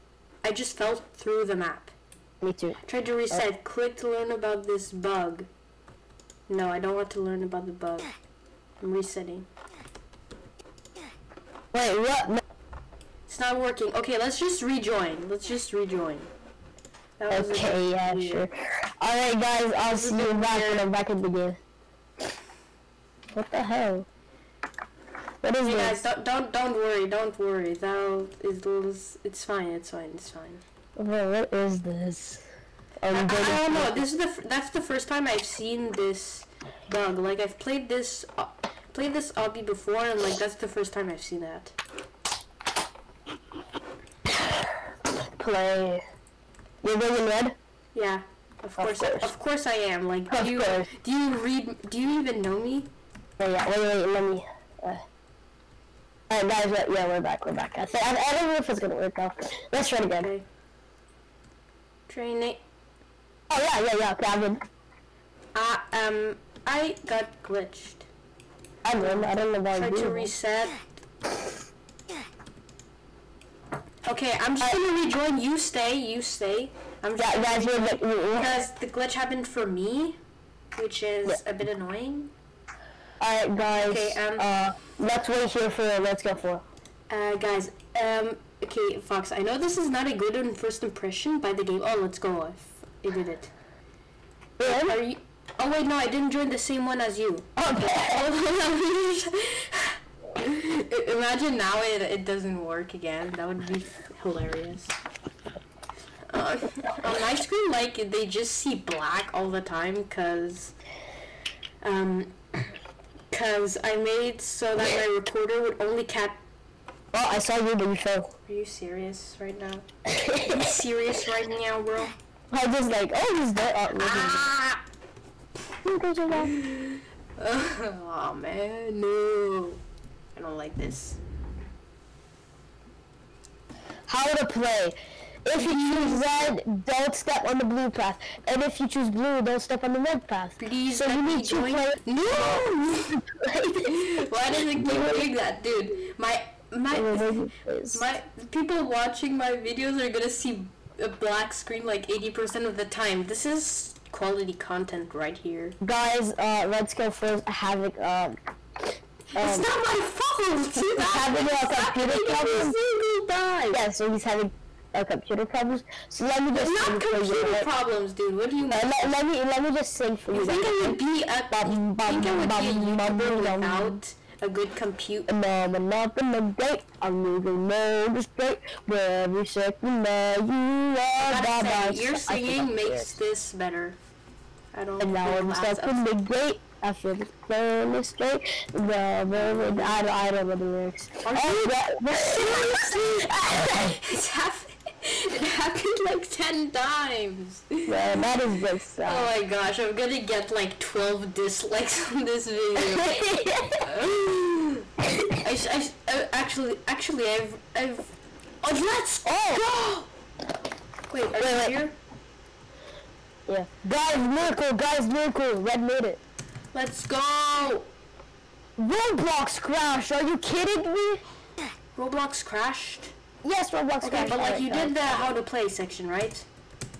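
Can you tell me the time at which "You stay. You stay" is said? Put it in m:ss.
1:15.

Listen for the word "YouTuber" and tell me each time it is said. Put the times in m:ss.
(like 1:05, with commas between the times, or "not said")
2:52.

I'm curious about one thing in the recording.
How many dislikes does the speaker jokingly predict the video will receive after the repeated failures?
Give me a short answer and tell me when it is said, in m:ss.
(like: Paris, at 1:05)
12, at 3:20.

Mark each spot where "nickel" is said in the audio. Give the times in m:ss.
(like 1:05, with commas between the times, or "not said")
not said.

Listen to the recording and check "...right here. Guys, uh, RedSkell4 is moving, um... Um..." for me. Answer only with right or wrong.
wrong.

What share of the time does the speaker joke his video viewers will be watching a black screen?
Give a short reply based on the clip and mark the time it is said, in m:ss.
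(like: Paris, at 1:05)
80%, at 2:32.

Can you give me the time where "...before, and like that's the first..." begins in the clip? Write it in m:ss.
0:39.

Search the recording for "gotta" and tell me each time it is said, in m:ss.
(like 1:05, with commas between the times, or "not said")
3:01.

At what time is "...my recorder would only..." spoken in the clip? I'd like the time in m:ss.
1:54.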